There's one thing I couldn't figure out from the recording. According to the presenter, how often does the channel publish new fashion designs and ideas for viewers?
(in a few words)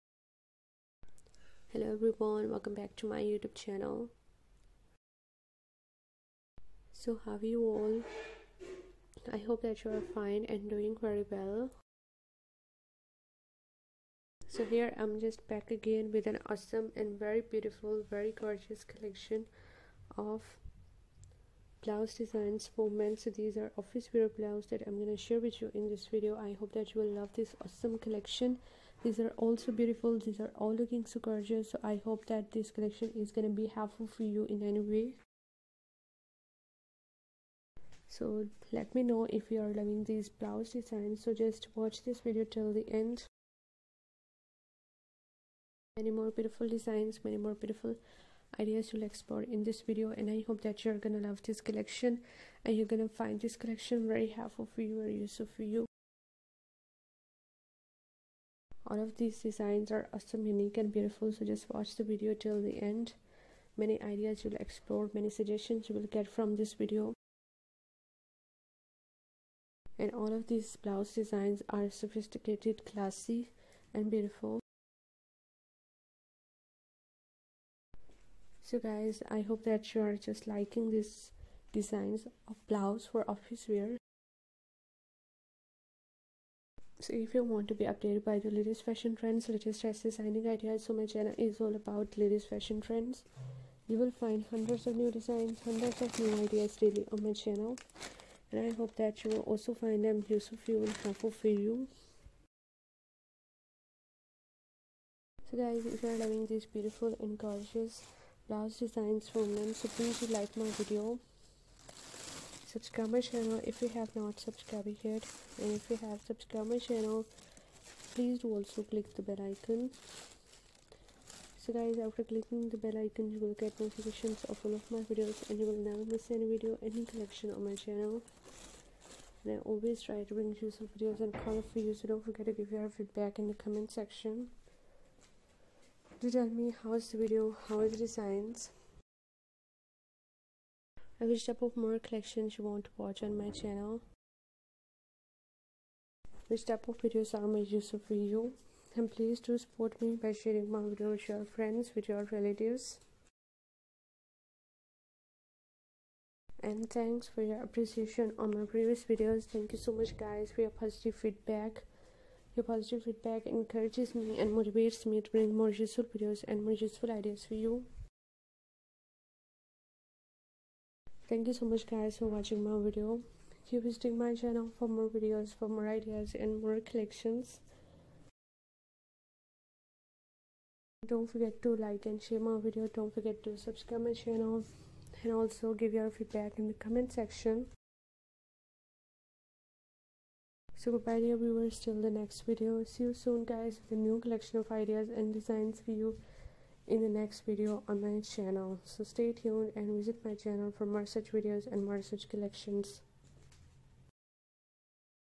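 Daily.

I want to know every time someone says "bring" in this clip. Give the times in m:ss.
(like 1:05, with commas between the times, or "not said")
2:10, 2:45.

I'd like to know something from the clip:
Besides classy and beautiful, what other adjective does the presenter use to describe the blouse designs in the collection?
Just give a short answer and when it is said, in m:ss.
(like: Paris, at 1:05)
Sophisticated, at 1:11.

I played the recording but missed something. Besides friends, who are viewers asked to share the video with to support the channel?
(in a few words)
Relatives.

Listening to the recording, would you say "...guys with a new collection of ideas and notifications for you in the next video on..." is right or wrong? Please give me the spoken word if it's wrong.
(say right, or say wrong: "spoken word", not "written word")
wrong: "designs", not "notifications".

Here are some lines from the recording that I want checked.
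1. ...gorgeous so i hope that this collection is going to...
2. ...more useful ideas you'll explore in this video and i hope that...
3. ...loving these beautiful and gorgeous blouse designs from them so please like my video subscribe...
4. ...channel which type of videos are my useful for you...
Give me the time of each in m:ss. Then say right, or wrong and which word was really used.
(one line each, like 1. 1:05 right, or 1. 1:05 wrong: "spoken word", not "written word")
1. 0:31 right
2. 0:47 wrong: "beautiful", not "useful"
3. 1:46 right
4. 2:23 right.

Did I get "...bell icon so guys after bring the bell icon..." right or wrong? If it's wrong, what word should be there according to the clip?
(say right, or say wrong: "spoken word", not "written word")
wrong: "clicking", not "bring".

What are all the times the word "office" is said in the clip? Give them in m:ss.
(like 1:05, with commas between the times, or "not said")
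0:23, 1:23.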